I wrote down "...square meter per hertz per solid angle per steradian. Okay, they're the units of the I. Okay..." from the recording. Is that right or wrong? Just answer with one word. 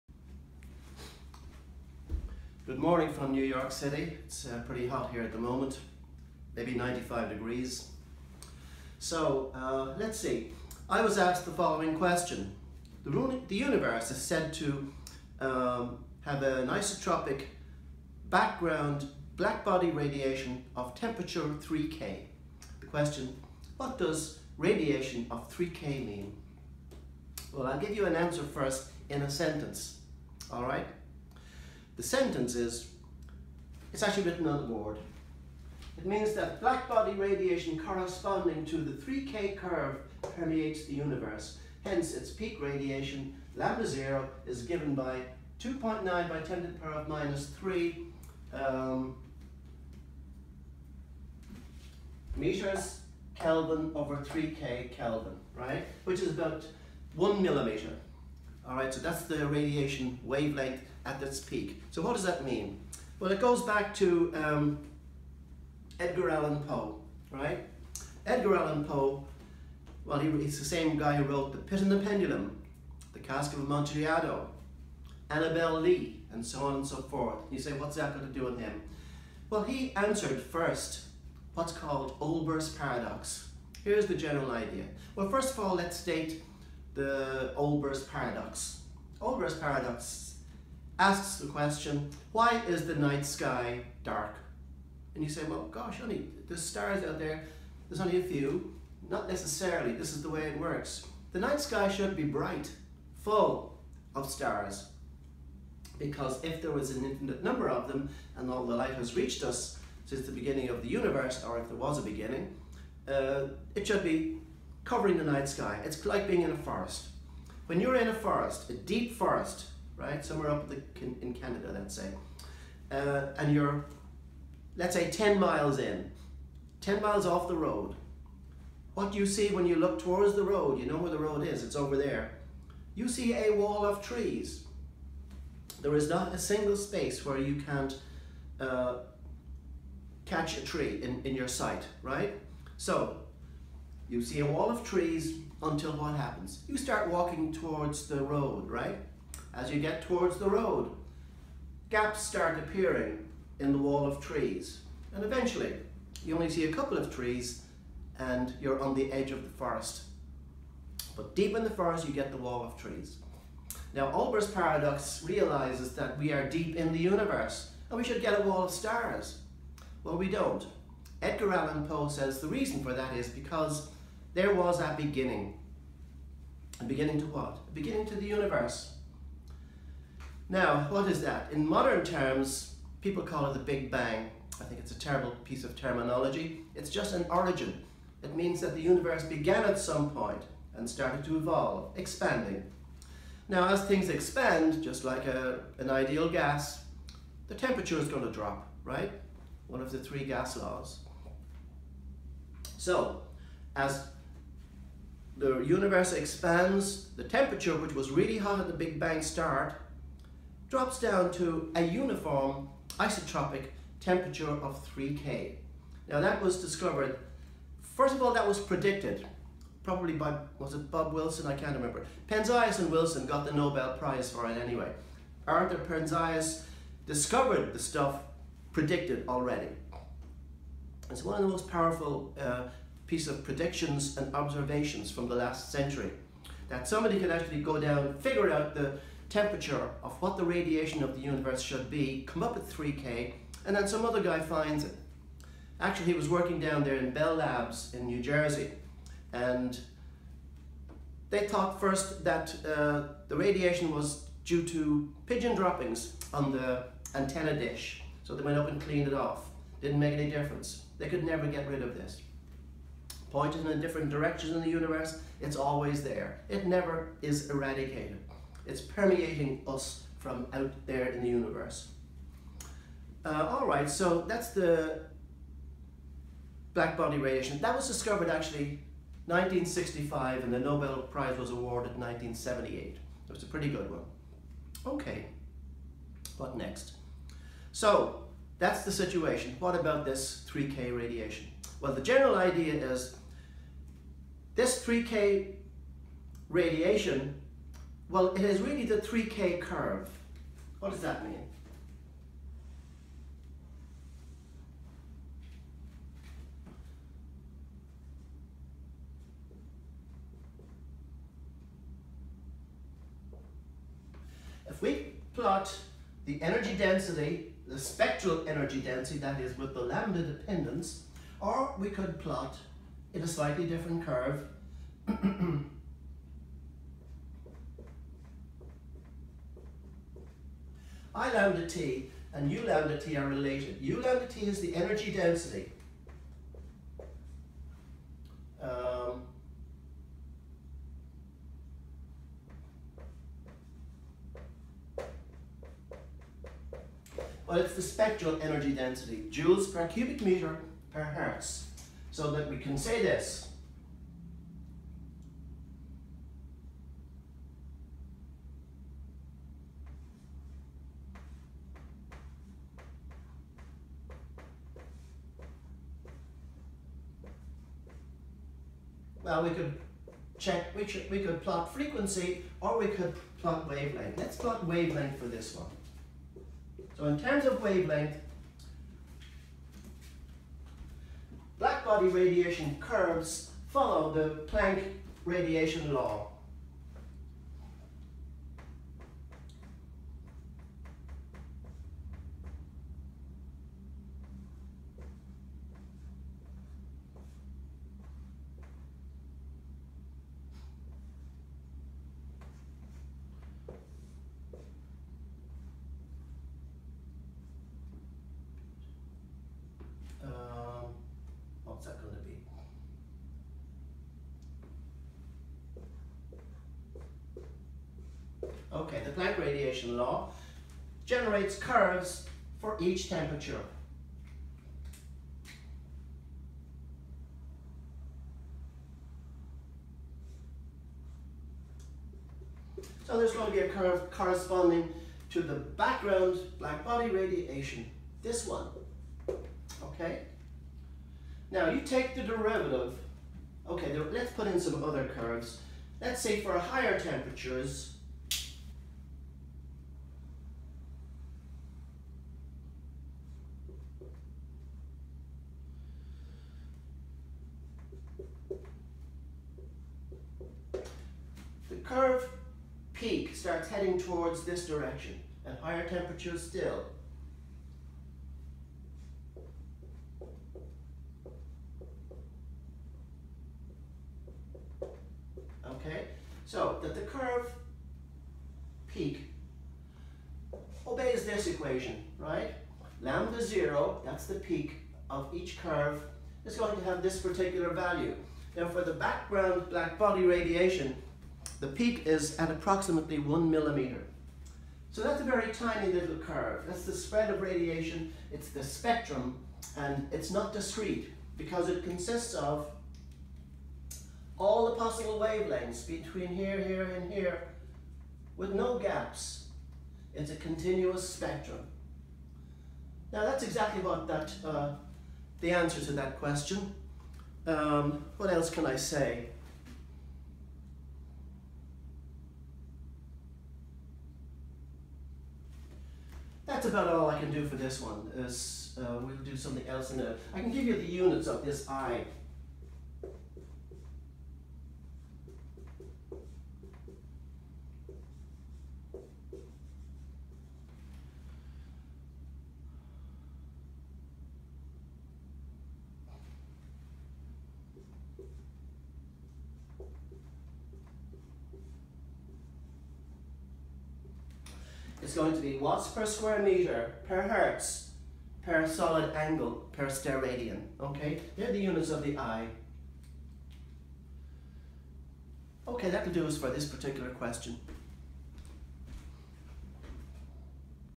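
right.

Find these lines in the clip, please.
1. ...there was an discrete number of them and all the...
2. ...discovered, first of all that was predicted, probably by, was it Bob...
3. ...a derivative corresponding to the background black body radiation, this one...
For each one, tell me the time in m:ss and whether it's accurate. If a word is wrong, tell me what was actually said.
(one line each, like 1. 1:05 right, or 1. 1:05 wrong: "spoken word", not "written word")
1. 1:46 wrong: "infinite", not "discrete"
2. 3:36 right
3. 7:13 wrong: "curve", not "derivative".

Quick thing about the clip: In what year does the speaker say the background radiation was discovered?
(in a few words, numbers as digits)
1965.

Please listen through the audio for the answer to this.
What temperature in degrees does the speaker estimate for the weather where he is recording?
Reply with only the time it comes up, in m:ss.
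0:06.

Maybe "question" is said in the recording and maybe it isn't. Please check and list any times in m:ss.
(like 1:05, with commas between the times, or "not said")
0:11, 0:22, 1:31, 8:36, 9:27.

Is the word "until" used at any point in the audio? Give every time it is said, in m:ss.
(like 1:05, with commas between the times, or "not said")
2:25.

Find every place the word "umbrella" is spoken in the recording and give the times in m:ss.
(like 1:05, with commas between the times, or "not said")
not said.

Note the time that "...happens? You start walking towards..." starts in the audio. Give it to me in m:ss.
2:26.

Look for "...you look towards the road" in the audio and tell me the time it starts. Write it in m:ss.
2:09.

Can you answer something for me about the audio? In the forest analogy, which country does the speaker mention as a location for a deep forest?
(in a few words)
Canada.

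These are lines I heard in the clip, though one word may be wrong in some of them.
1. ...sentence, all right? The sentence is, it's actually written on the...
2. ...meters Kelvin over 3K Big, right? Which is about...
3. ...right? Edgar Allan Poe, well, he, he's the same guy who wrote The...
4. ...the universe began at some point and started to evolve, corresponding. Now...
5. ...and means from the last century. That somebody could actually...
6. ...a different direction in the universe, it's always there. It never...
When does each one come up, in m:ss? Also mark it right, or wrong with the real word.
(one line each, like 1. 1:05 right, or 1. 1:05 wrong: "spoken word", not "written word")
1. 0:29 right
2. 0:52 wrong: "Kelvin", not "Big"
3. 1:07 right
4. 3:08 wrong: "expanding", not "corresponding"
5. 3:54 wrong: "observations", not "means"
6. 4:23 right.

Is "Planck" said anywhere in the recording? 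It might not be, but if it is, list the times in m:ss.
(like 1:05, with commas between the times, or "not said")
6:24, 6:59.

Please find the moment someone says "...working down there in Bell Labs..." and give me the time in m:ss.
4:06.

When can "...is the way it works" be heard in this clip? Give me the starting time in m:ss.
1:40.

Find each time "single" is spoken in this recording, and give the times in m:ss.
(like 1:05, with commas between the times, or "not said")
2:16.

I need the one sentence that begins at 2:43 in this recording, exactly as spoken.
Now Olber's paradox realizes that we are deep in the universe and we should get a wall of stars.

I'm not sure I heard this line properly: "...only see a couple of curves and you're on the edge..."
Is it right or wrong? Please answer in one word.
wrong.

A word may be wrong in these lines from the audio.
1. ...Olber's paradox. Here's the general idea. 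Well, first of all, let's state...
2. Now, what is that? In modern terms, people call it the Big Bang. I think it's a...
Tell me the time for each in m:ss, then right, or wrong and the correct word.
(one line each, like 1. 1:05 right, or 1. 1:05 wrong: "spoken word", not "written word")
1. 1:22 right
2. 3:00 right.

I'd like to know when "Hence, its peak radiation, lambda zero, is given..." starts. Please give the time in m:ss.
0:41.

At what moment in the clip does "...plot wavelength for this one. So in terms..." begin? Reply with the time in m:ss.
6:14.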